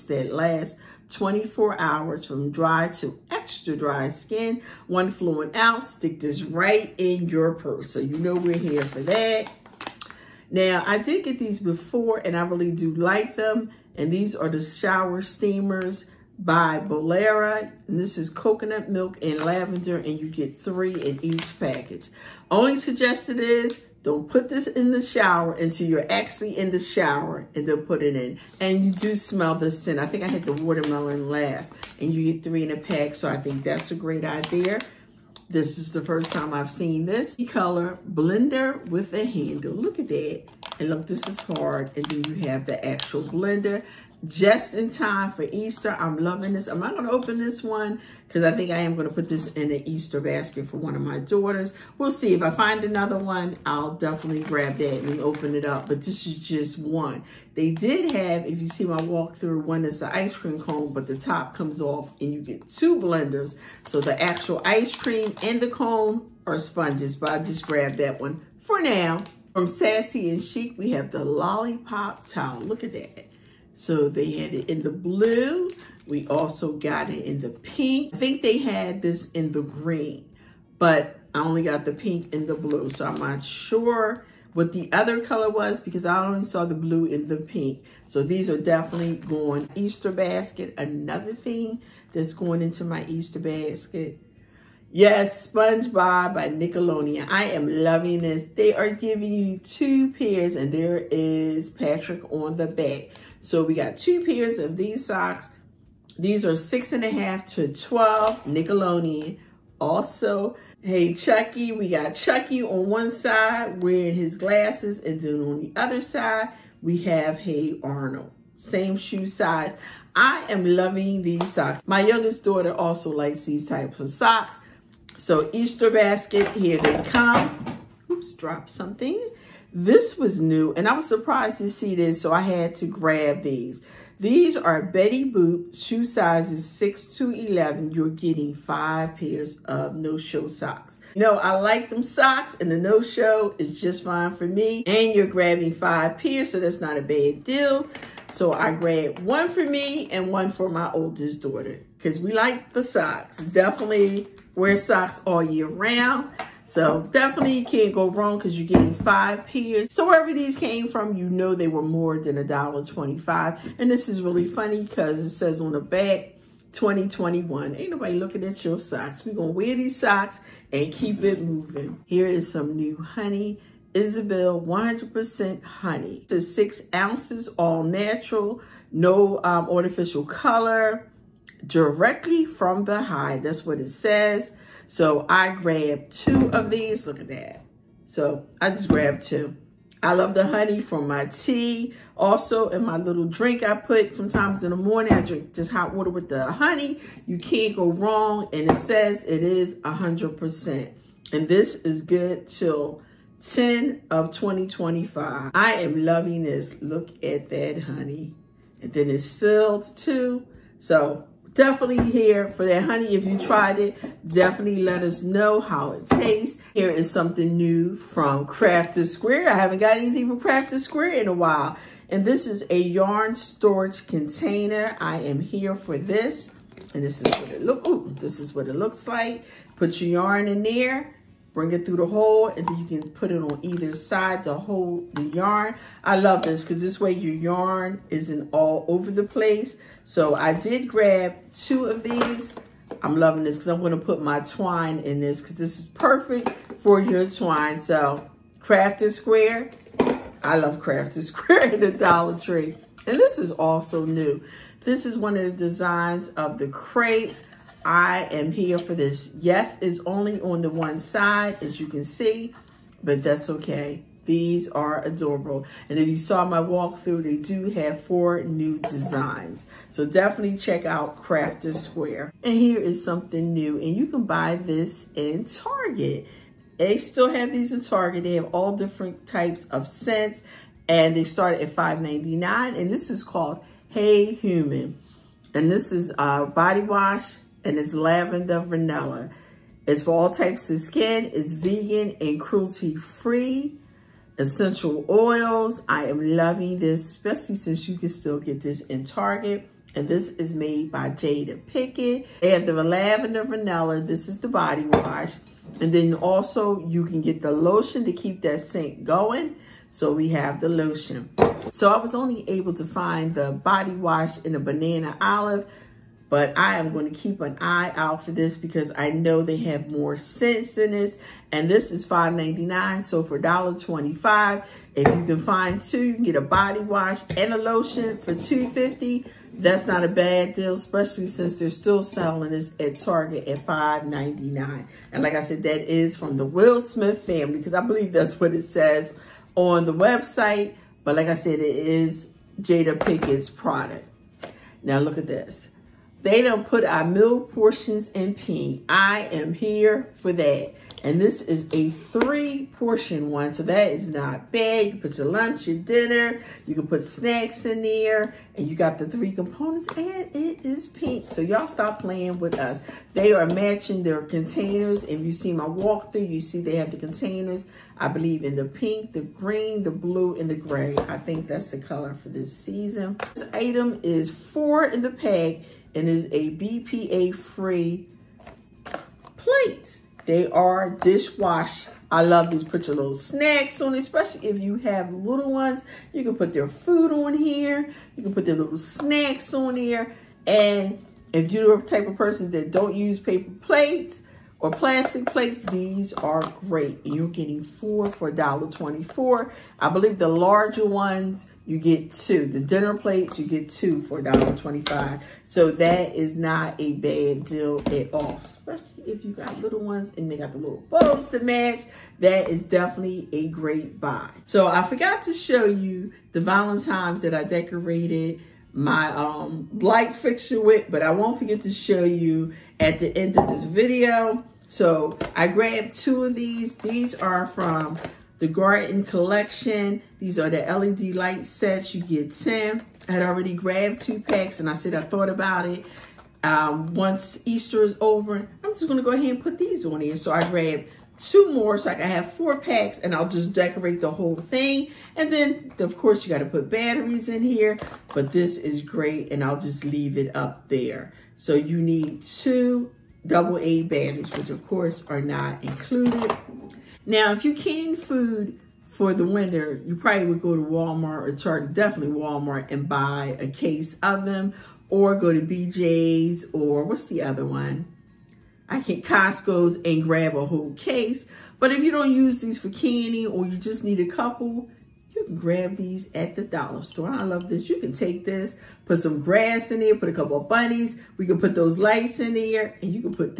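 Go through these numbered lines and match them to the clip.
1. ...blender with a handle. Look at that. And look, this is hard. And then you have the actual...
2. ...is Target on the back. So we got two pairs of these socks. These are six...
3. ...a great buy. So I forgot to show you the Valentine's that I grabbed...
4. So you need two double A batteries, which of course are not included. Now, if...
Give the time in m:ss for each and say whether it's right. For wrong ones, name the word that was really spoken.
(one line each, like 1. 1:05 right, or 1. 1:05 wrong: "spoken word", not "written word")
1. 0:38 right
2. 1:41 wrong: "Patrick", not "Target"
3. 6:53 wrong: "decorated", not "grabbed"
4. 7:31 right.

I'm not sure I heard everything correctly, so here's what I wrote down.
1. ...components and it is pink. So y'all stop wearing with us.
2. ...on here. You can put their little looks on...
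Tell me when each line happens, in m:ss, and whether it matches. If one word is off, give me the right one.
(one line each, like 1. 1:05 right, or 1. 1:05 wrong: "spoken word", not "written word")
1. 5:59 wrong: "playing", not "wearing"
2. 6:27 wrong: "snacks", not "looks".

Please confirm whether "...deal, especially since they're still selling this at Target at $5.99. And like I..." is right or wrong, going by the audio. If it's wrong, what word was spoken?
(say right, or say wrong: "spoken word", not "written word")
right.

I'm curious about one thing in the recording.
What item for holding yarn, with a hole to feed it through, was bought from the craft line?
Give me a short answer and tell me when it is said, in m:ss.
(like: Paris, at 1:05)
yarn storage container, at 3:42.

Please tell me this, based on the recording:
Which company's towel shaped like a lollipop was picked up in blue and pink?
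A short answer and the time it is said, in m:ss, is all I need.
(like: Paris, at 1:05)
Sassy and Chic, at 1:09.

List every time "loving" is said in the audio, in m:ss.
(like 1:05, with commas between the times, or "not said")
0:46, 1:37, 2:00, 3:26, 4:03, 4:56.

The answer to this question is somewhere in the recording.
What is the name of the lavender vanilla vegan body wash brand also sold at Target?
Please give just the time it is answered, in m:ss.
4:43.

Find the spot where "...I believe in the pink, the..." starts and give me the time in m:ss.
6:07.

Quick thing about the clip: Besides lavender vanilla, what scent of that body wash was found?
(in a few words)
banana olive.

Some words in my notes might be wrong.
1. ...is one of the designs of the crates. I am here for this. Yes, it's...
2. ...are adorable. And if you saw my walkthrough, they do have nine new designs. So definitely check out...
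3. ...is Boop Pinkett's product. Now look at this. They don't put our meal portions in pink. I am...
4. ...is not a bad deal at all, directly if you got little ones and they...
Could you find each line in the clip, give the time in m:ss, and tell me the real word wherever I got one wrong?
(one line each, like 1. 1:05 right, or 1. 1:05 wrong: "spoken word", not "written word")
1. 4:15 right
2. 4:24 wrong: "four", not "nine"
3. 5:41 wrong: "Jada", not "Boop"
4. 6:46 wrong: "especially", not "directly".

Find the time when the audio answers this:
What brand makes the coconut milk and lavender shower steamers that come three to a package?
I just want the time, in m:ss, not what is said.
0:16.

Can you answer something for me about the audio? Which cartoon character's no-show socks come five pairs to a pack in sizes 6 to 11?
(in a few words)
Betty Boop.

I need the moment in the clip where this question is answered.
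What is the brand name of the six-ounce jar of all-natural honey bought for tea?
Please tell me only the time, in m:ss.
2:53.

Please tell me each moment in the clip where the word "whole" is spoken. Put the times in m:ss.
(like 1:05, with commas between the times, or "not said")
7:24, 7:50.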